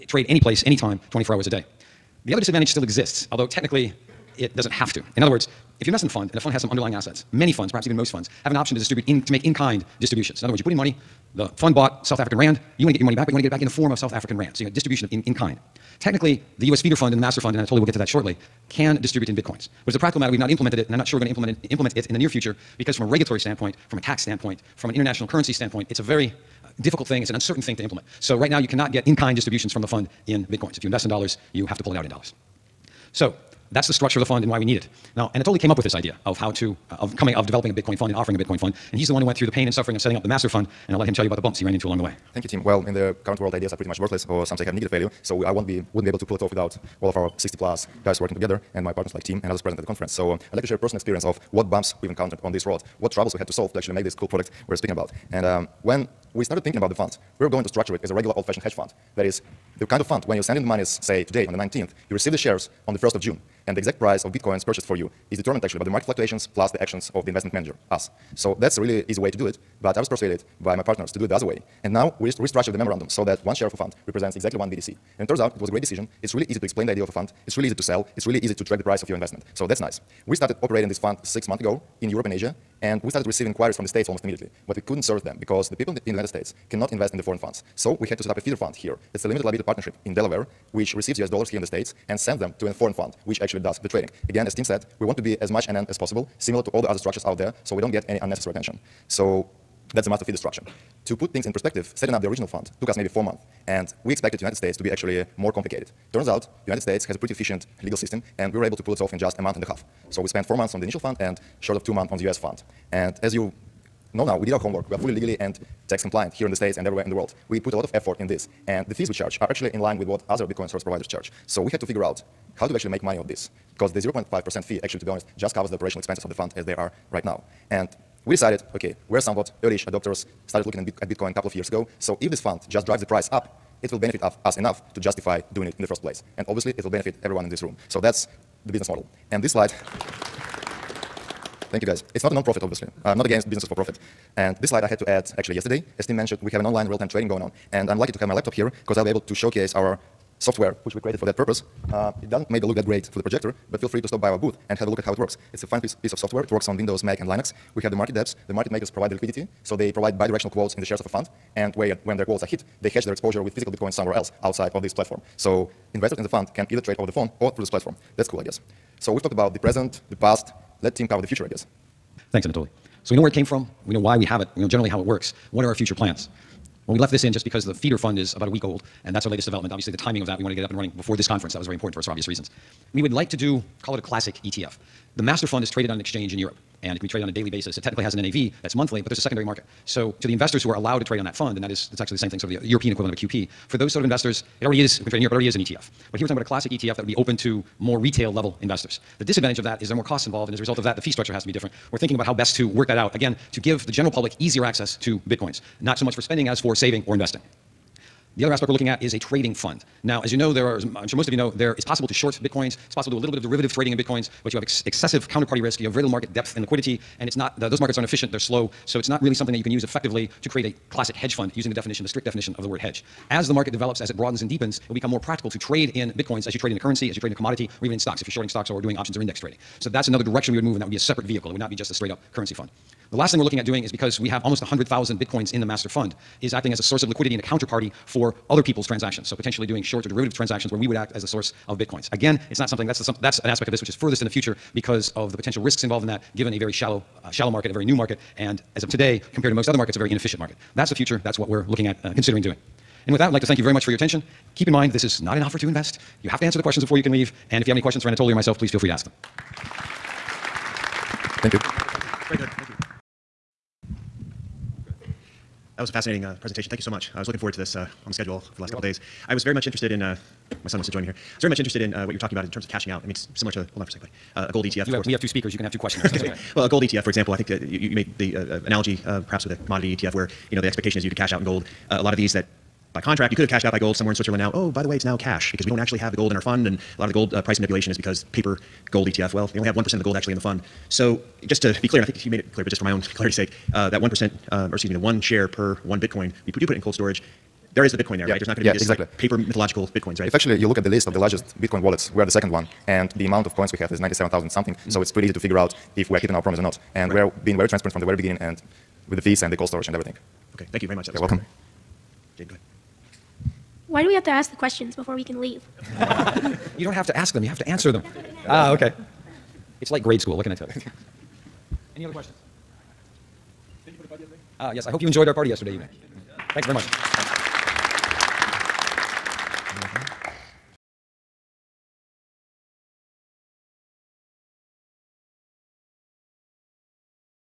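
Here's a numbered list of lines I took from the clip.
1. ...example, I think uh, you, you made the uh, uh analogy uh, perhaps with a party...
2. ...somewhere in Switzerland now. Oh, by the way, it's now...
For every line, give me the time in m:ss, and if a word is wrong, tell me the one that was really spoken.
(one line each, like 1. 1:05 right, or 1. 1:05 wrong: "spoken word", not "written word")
1. 4:37 wrong: "commodity", not "party"
2. 4:43 right.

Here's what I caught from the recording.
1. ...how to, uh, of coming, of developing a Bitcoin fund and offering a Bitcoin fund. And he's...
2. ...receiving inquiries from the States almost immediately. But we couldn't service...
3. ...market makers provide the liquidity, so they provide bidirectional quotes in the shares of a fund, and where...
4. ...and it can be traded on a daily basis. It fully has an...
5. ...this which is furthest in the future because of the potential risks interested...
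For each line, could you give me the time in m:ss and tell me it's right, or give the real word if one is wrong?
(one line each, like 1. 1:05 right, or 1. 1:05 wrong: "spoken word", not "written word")
1. 0:36 right
2. 1:23 right
3. 2:38 right
4. 3:06 wrong: "technically", not "fully"
5. 4:03 wrong: "involved", not "interested".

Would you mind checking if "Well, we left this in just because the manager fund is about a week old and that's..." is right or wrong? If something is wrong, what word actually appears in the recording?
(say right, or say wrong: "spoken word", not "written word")
wrong: "feeder", not "manager".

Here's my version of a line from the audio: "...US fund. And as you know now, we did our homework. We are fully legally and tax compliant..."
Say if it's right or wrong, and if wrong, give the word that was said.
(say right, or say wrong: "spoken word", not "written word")
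right.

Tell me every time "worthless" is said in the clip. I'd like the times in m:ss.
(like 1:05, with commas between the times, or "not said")
0:43.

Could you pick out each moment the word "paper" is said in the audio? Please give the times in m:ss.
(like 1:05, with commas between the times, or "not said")
4:48, 4:59.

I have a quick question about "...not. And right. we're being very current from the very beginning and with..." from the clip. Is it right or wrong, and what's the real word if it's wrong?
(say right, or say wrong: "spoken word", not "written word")
wrong: "transparent", not "current".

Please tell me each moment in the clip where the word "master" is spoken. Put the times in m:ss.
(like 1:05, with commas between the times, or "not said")
0:17, 0:40, 1:40, 3:05, 3:55.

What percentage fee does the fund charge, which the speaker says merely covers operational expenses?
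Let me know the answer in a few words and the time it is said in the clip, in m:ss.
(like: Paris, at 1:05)
0.5%, at 2:03.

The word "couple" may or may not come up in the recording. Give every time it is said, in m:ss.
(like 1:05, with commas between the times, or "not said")
2:11, 4:28.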